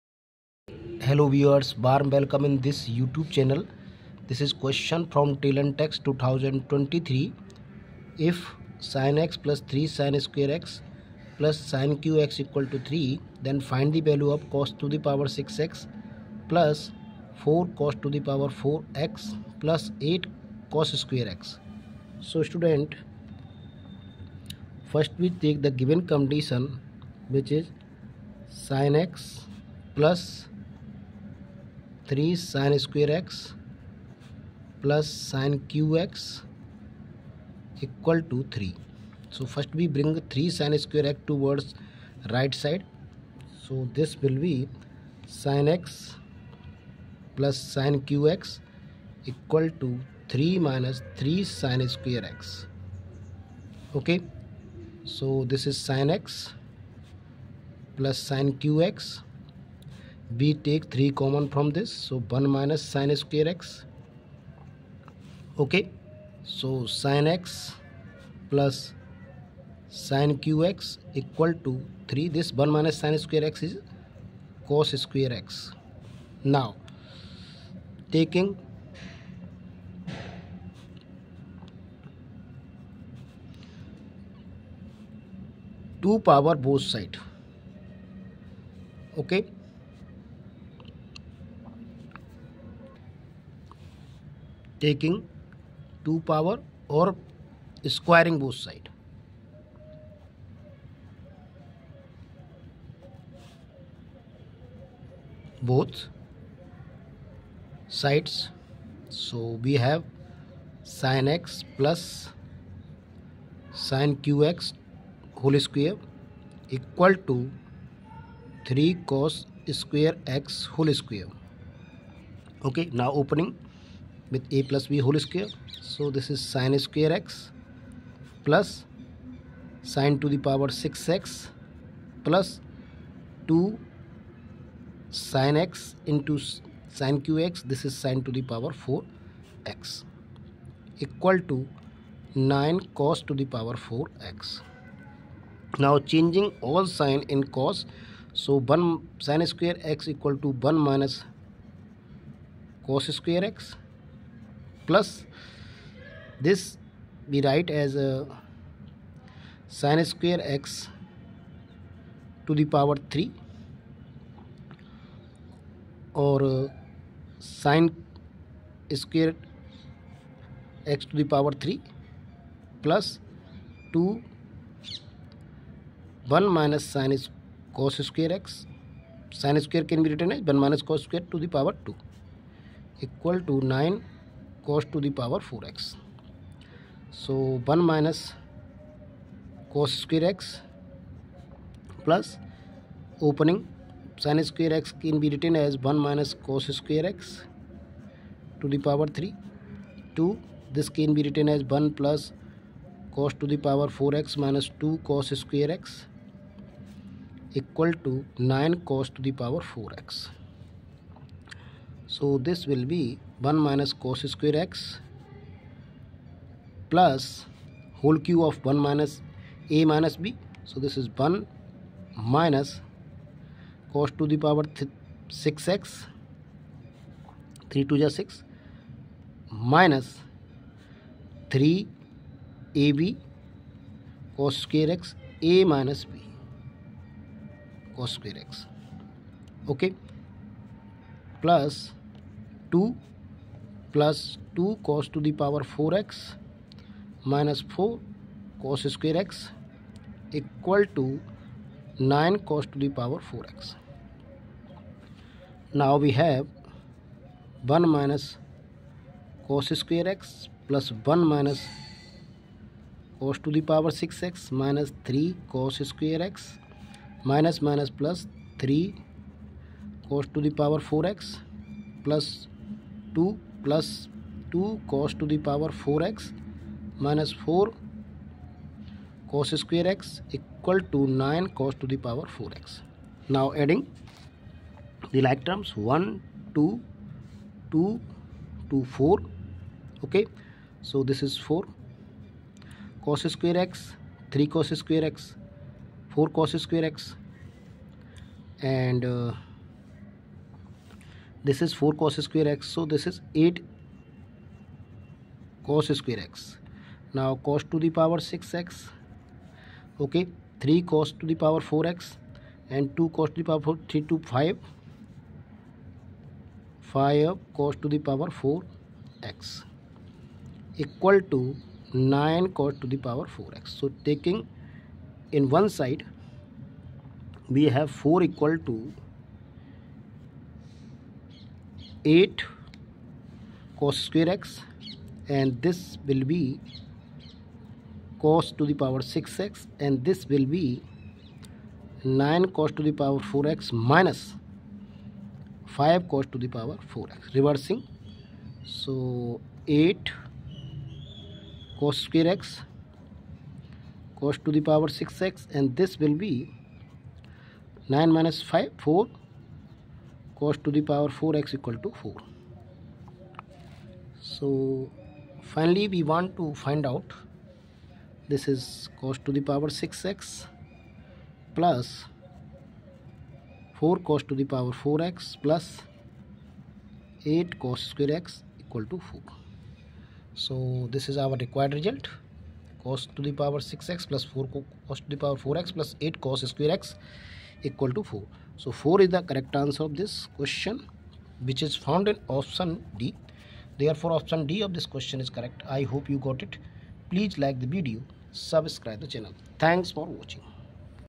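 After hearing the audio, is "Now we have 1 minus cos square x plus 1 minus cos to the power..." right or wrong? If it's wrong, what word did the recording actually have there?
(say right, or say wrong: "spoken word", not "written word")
right.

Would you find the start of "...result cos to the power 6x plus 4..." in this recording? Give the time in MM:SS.
06:21.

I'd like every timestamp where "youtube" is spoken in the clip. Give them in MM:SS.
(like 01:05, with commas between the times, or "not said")
00:02.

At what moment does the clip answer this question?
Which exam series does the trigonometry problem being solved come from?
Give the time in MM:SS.
00:05.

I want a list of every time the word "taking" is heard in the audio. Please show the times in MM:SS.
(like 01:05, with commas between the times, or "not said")
01:18, 01:34, 05:24.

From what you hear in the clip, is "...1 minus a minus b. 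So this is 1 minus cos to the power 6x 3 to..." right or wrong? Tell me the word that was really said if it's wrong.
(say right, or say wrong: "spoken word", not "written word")
right.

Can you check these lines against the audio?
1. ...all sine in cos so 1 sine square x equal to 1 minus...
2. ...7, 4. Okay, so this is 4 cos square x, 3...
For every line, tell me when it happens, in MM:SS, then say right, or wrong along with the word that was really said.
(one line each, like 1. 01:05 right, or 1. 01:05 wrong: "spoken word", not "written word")
1. 02:26 right
2. 04:48 wrong: "2", not "7".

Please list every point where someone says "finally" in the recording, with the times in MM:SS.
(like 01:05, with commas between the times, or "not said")
06:05.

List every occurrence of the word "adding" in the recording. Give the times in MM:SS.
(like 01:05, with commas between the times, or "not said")
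04:43.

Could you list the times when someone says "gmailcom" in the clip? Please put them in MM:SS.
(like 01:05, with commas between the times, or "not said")
not said.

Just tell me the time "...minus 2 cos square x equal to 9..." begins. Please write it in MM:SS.
03:24.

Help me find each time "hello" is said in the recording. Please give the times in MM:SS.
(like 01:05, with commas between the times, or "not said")
00:01.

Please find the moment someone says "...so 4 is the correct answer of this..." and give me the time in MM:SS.
06:28.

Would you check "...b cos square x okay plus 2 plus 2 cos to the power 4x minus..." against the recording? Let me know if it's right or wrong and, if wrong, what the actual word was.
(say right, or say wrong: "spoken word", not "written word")
right.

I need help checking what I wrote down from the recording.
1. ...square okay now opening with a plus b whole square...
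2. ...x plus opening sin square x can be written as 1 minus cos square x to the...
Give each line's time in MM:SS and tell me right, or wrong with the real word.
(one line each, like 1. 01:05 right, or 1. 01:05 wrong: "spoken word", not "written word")
1. 02:01 right
2. 03:10 right.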